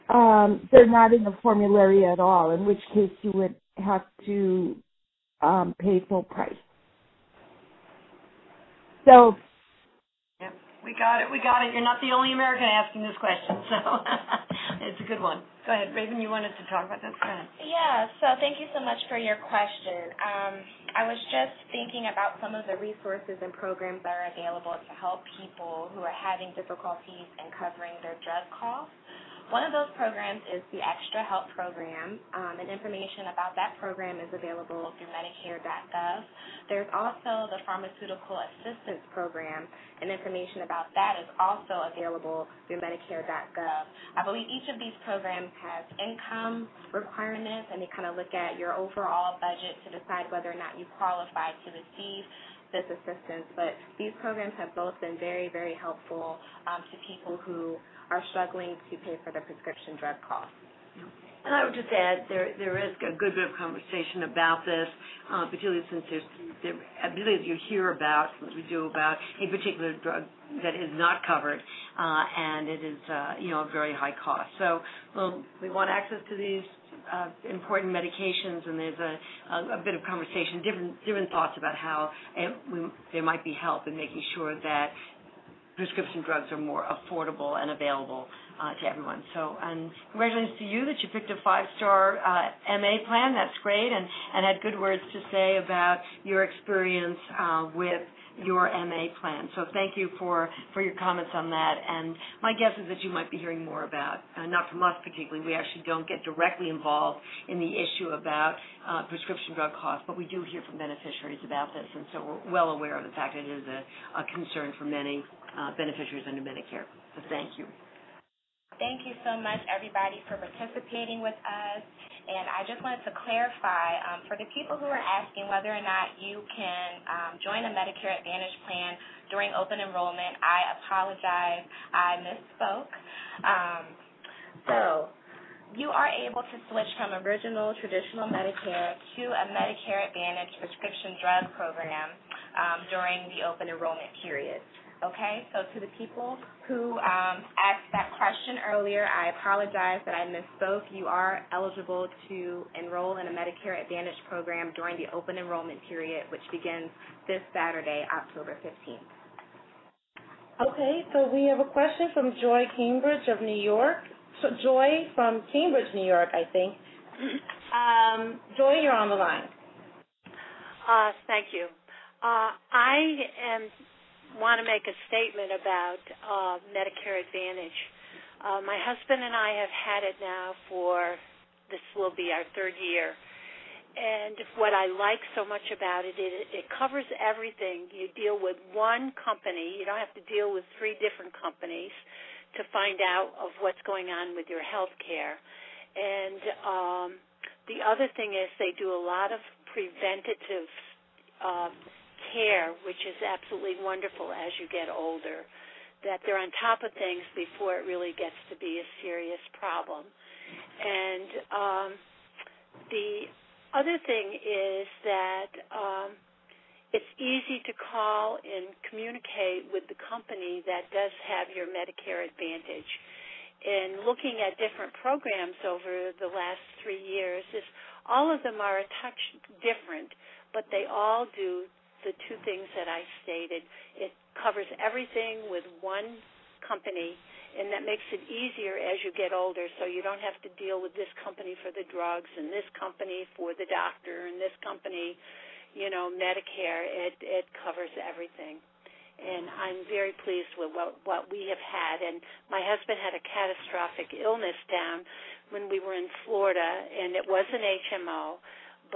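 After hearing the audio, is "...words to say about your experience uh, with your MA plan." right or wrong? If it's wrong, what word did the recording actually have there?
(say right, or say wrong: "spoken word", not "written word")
right.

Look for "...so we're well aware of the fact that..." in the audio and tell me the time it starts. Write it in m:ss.
1:52.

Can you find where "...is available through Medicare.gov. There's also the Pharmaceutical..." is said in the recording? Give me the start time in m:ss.
0:34.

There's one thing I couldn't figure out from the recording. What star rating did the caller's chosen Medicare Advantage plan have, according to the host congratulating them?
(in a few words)
five-star.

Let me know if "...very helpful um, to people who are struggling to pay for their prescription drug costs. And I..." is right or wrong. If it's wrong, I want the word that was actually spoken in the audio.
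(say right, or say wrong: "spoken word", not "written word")
right.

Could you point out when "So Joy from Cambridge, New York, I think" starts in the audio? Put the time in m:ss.
2:44.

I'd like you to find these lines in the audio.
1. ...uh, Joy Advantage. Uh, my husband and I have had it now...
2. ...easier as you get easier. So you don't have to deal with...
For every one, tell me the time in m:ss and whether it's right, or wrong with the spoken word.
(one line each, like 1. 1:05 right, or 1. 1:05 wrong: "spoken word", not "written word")
1. 2:56 wrong: "Medicare", not "Joy"
2. 3:58 wrong: "older", not "easier".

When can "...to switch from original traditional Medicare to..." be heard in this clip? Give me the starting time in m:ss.
2:16.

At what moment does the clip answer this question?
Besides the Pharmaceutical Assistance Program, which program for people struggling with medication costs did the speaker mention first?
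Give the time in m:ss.
0:30.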